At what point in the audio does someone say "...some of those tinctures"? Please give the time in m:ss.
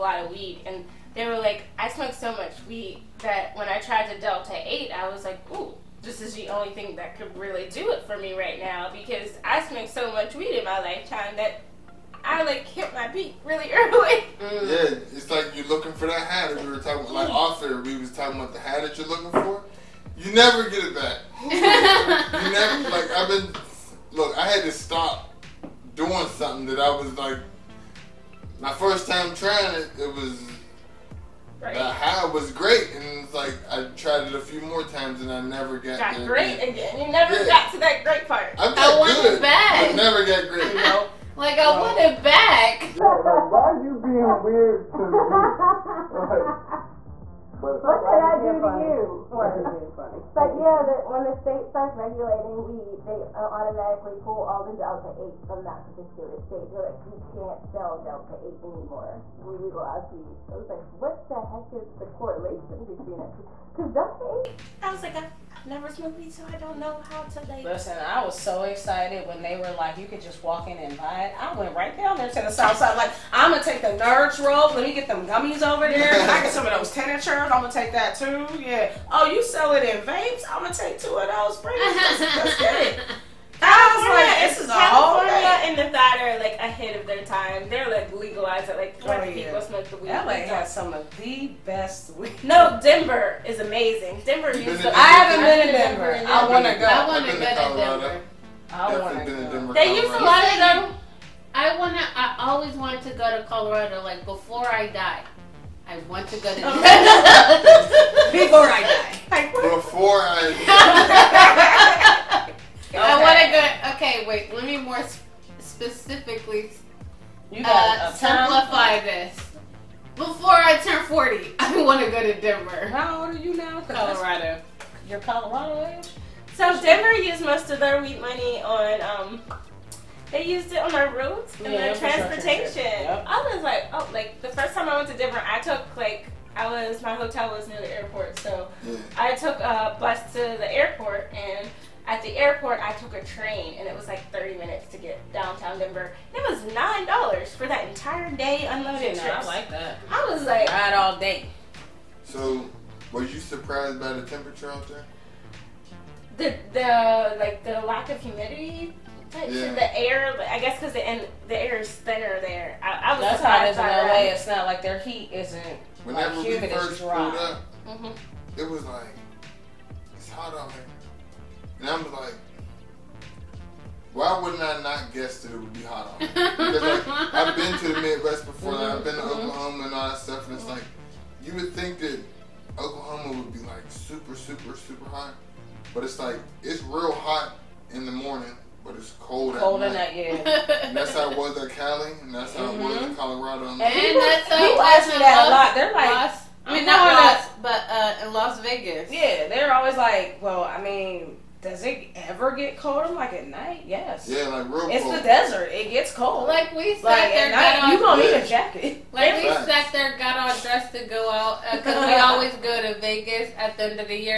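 1:16.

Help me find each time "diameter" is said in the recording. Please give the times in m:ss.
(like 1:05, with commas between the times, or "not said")
not said.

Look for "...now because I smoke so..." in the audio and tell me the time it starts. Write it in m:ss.
0:08.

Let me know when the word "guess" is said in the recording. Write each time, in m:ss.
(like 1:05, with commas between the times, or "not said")
2:40, 2:55.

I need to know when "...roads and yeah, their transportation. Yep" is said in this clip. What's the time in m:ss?
2:11.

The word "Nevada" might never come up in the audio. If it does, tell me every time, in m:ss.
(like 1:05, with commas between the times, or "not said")
1:25.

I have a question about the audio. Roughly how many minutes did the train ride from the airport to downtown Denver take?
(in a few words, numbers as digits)
30 minutes.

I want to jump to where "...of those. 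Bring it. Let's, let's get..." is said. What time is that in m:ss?
1:21.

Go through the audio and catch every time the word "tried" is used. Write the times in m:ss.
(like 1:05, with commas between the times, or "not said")
0:03, 0:33.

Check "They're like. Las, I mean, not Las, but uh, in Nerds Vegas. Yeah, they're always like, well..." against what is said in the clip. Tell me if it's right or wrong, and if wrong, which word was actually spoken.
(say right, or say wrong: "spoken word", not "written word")
wrong: "Las", not "Nerds".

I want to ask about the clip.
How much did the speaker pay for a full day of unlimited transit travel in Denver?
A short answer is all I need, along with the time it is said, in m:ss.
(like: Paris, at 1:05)
$9, at 2:26.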